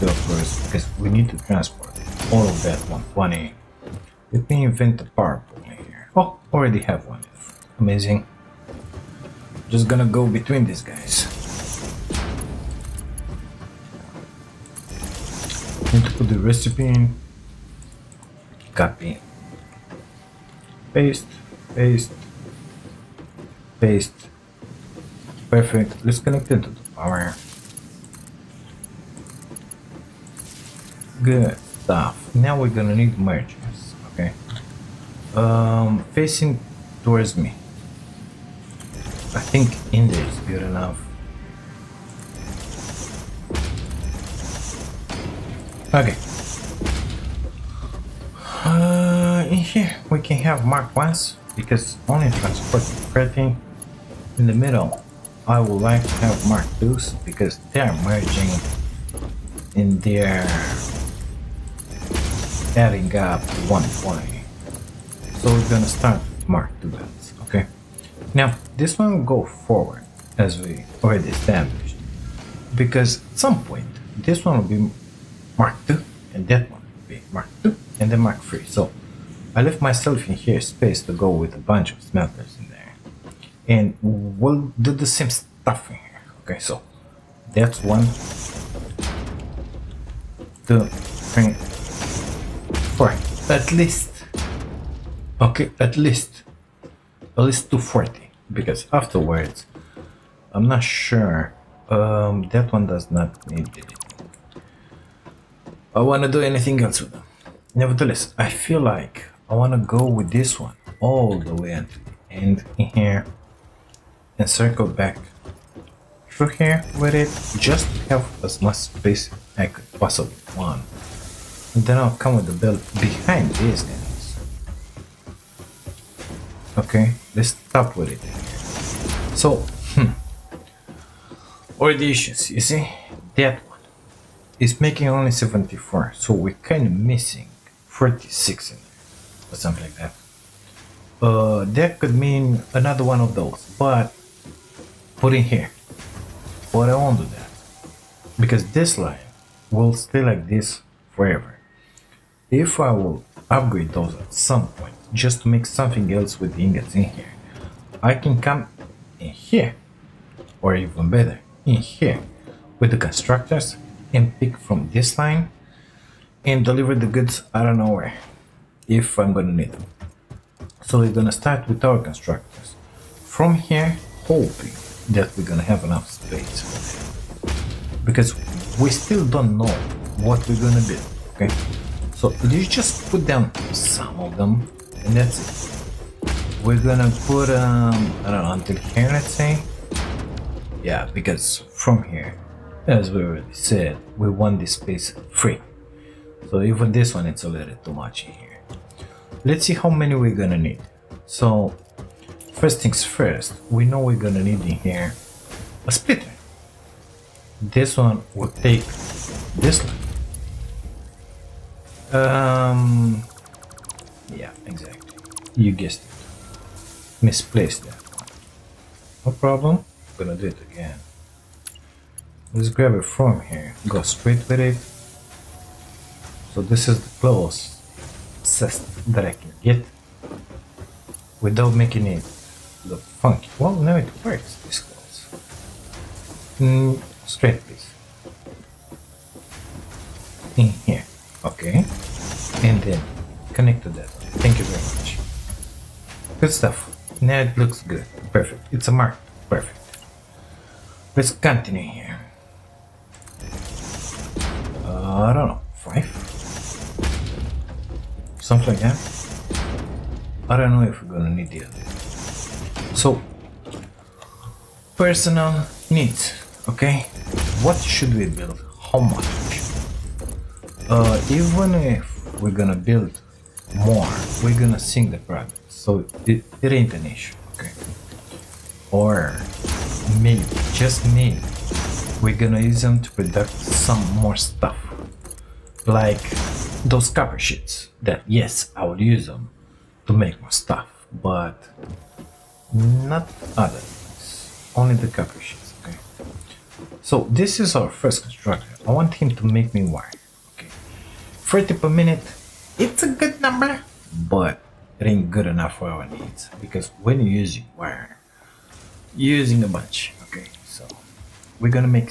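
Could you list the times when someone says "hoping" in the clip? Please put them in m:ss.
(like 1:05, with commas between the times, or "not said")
2:54.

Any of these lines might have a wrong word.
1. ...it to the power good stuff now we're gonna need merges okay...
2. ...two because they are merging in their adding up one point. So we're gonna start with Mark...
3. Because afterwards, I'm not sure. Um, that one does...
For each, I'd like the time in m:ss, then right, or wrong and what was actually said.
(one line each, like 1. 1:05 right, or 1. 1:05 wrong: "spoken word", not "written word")
1. 0:26 right
2. 0:56 right
3. 1:38 right.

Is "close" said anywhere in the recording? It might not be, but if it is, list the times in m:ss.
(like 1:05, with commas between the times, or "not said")
3:47, 3:54.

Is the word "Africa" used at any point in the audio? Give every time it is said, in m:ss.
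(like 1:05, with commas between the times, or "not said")
not said.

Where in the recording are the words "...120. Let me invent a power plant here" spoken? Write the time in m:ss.
0:02.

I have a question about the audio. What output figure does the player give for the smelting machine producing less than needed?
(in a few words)
74.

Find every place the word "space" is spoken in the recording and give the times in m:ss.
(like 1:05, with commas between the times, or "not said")
1:20, 1:58, 2:56, 3:14.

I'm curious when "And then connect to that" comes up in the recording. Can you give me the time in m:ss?
4:02.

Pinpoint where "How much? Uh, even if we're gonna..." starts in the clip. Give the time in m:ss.
4:28.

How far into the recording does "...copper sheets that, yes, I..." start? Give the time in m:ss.
4:47.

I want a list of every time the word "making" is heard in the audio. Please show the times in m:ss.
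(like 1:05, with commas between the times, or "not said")
2:14, 3:51.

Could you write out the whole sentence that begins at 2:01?
And then I'll come with the belt behind these guys.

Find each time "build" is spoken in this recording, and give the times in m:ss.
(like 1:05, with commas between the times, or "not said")
3:00, 4:28, 4:32.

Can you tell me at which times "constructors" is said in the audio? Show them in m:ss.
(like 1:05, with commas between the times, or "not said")
2:42, 2:51, 4:58.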